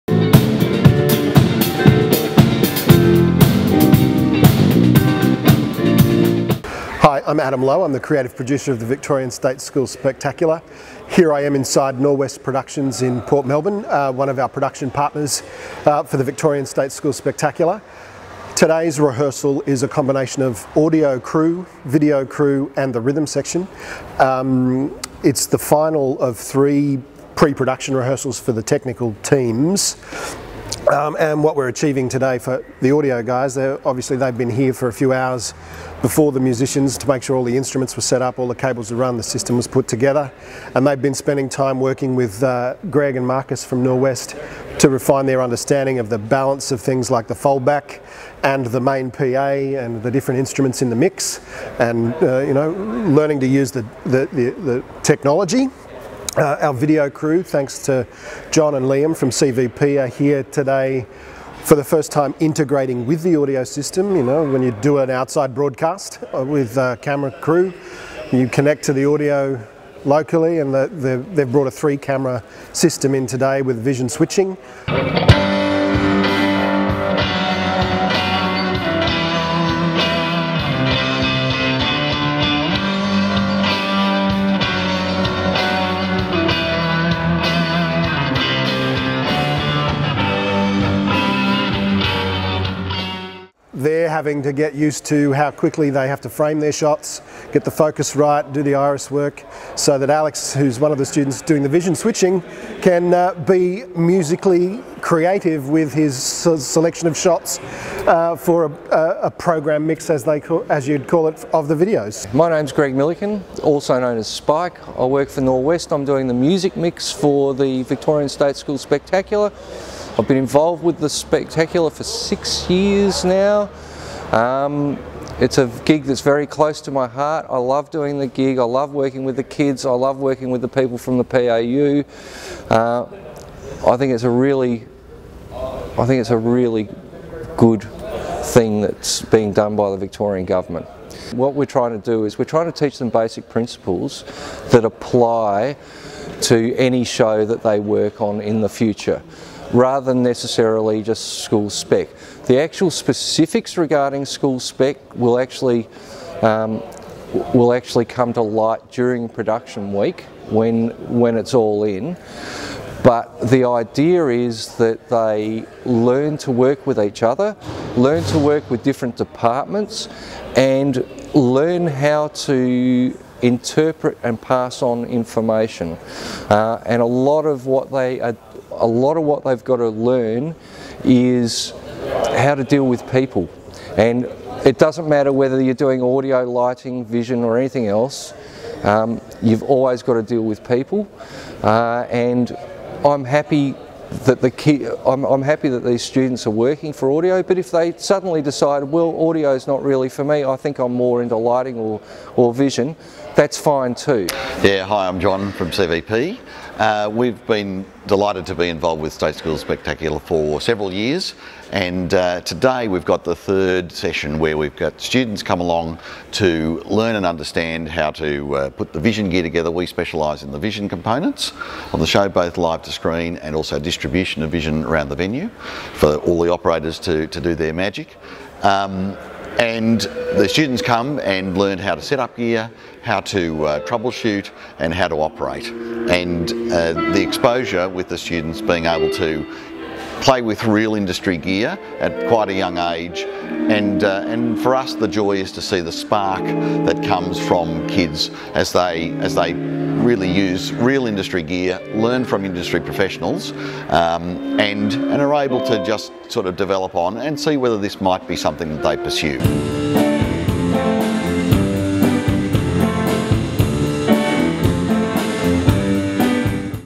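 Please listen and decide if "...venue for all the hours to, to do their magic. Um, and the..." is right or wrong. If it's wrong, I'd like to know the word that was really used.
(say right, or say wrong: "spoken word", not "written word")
wrong: "operators", not "hours".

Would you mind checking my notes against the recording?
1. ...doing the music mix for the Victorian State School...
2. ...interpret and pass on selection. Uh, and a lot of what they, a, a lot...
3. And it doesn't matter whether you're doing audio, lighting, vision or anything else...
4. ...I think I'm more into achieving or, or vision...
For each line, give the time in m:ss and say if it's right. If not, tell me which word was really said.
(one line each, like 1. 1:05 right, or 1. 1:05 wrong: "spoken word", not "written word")
1. 1:56 right
2. 2:53 wrong: "information", not "selection"
3. 3:03 right
4. 3:20 wrong: "lighting", not "achieving".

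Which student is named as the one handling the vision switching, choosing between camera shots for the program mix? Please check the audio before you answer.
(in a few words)
Alex.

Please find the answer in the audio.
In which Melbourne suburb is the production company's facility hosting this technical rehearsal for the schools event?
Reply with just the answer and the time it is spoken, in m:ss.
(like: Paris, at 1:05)
Port Melbourne, at 0:13.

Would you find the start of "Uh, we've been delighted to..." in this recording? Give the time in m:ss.
3:26.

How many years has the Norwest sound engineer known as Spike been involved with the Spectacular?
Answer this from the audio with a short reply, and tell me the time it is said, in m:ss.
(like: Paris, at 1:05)
6 years, at 2:02.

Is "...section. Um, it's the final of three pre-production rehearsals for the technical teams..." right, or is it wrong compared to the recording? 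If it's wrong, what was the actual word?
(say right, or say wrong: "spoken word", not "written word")
right.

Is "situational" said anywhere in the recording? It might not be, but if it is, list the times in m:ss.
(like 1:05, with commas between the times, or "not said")
not said.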